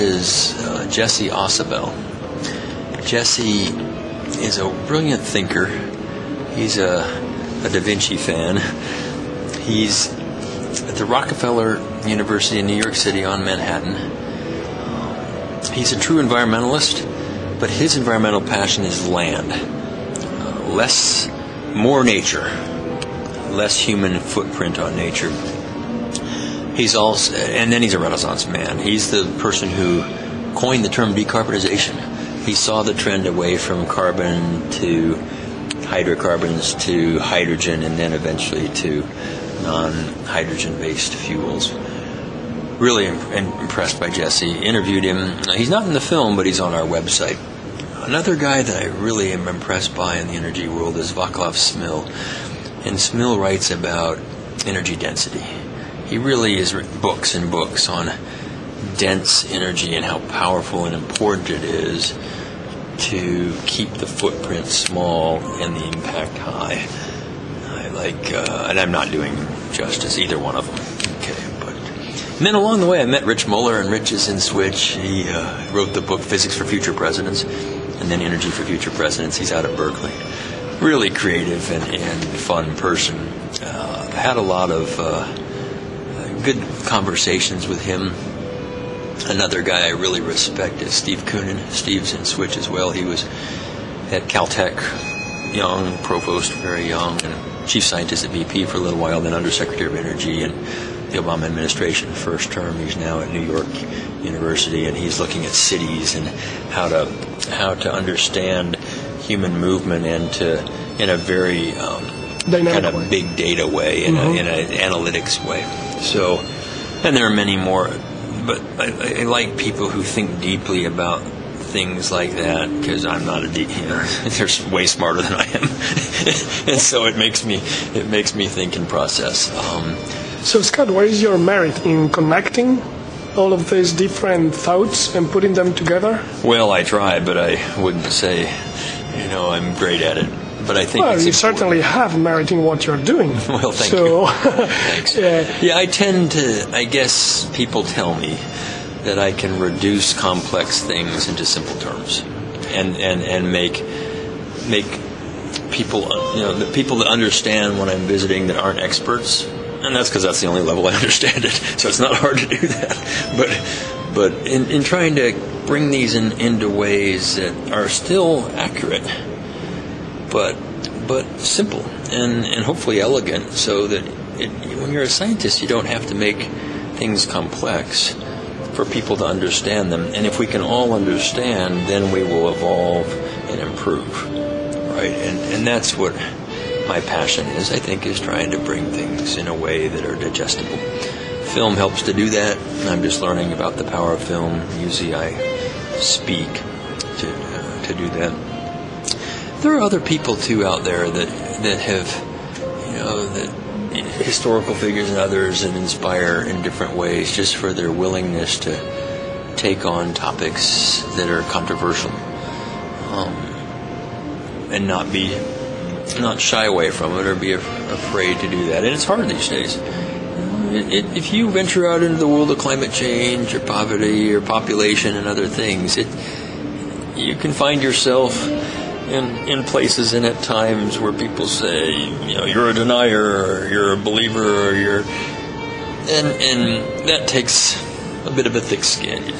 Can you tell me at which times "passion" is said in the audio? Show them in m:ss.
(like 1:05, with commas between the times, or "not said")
0:18, 3:07.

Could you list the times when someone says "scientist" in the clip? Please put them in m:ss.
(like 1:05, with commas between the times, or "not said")
1:37, 2:55.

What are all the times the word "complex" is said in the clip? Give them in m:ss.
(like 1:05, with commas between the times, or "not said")
2:30, 2:57.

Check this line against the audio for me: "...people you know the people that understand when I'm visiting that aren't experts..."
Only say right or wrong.
right.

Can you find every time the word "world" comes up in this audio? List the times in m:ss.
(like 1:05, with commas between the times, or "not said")
0:50, 3:42.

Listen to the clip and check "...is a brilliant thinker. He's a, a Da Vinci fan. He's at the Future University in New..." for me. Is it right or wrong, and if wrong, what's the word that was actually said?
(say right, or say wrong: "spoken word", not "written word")
wrong: "Rockefeller", not "Future".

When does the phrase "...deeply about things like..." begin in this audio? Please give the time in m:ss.
2:00.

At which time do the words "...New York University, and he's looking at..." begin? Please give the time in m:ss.
1:43.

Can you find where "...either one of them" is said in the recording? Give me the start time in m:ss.
1:10.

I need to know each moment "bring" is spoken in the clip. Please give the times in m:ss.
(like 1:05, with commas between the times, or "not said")
2:45, 3:08.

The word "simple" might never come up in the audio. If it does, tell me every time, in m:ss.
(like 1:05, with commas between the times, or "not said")
2:31, 2:51.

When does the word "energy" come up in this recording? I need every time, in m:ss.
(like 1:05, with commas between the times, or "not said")
0:50, 0:54, 0:59, 1:18, 1:39.